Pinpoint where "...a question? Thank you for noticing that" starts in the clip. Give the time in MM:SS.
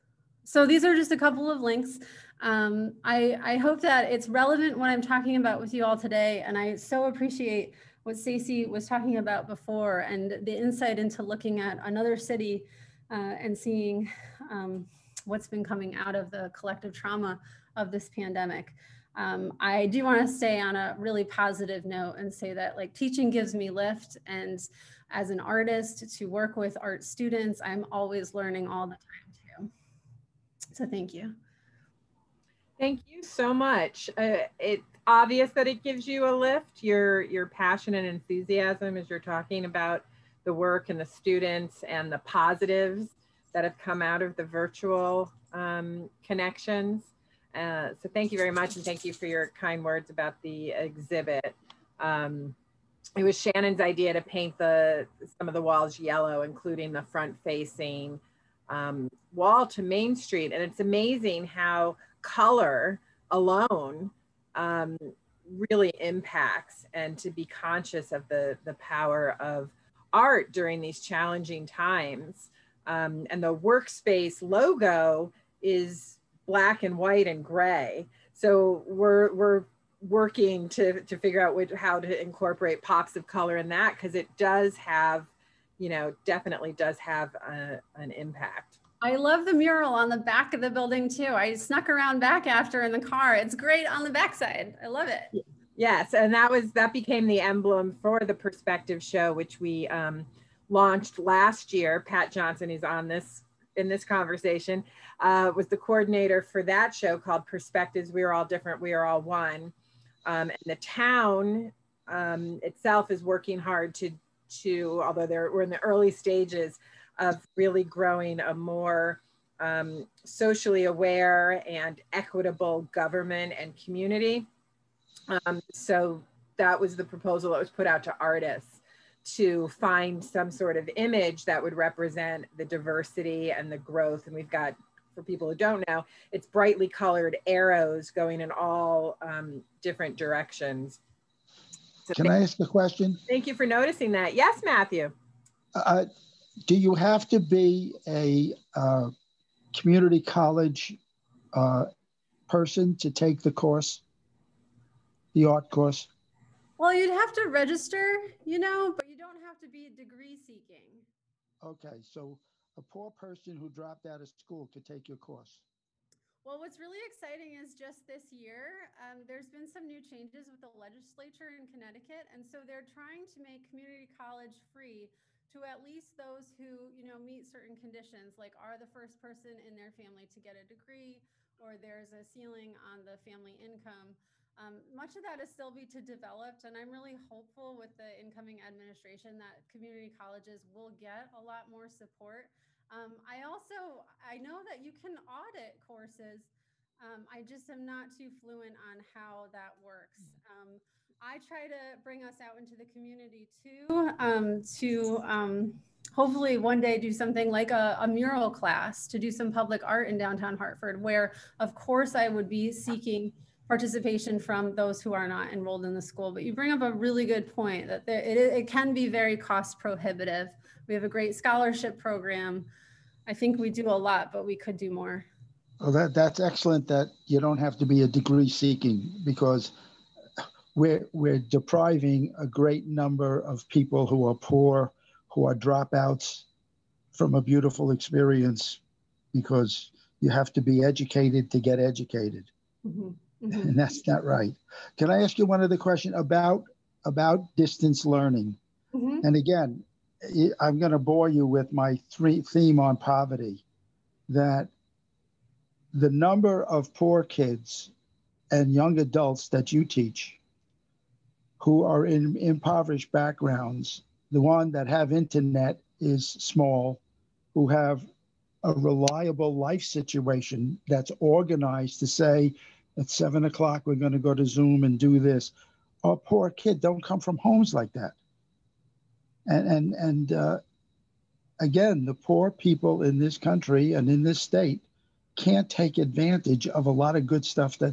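02:22.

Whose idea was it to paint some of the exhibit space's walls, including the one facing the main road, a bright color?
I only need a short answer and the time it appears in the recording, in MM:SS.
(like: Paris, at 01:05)
Shannon, at 00:53.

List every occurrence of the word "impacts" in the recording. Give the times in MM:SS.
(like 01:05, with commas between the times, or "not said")
01:05, 01:28.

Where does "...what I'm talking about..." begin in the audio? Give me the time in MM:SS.
00:04.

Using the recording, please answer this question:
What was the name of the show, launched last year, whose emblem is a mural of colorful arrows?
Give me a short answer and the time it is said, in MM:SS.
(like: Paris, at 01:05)
Perspectives, at 01:47.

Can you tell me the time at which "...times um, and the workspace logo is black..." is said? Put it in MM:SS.
01:11.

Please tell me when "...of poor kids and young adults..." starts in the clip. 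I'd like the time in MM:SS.
04:16.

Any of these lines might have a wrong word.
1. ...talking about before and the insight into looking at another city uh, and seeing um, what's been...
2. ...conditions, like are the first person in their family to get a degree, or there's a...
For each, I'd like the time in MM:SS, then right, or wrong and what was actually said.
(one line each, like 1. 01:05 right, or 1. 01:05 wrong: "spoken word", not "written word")
1. 00:08 right
2. 02:57 right.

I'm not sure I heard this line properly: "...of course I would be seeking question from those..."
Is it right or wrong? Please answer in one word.
wrong.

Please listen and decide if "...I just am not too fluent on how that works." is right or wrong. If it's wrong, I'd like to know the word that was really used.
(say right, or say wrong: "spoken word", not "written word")
right.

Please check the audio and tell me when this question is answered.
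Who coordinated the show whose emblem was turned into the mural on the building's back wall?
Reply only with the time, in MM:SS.
01:41.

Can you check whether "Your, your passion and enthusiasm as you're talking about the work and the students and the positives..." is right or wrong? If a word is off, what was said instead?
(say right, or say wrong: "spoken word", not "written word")
right.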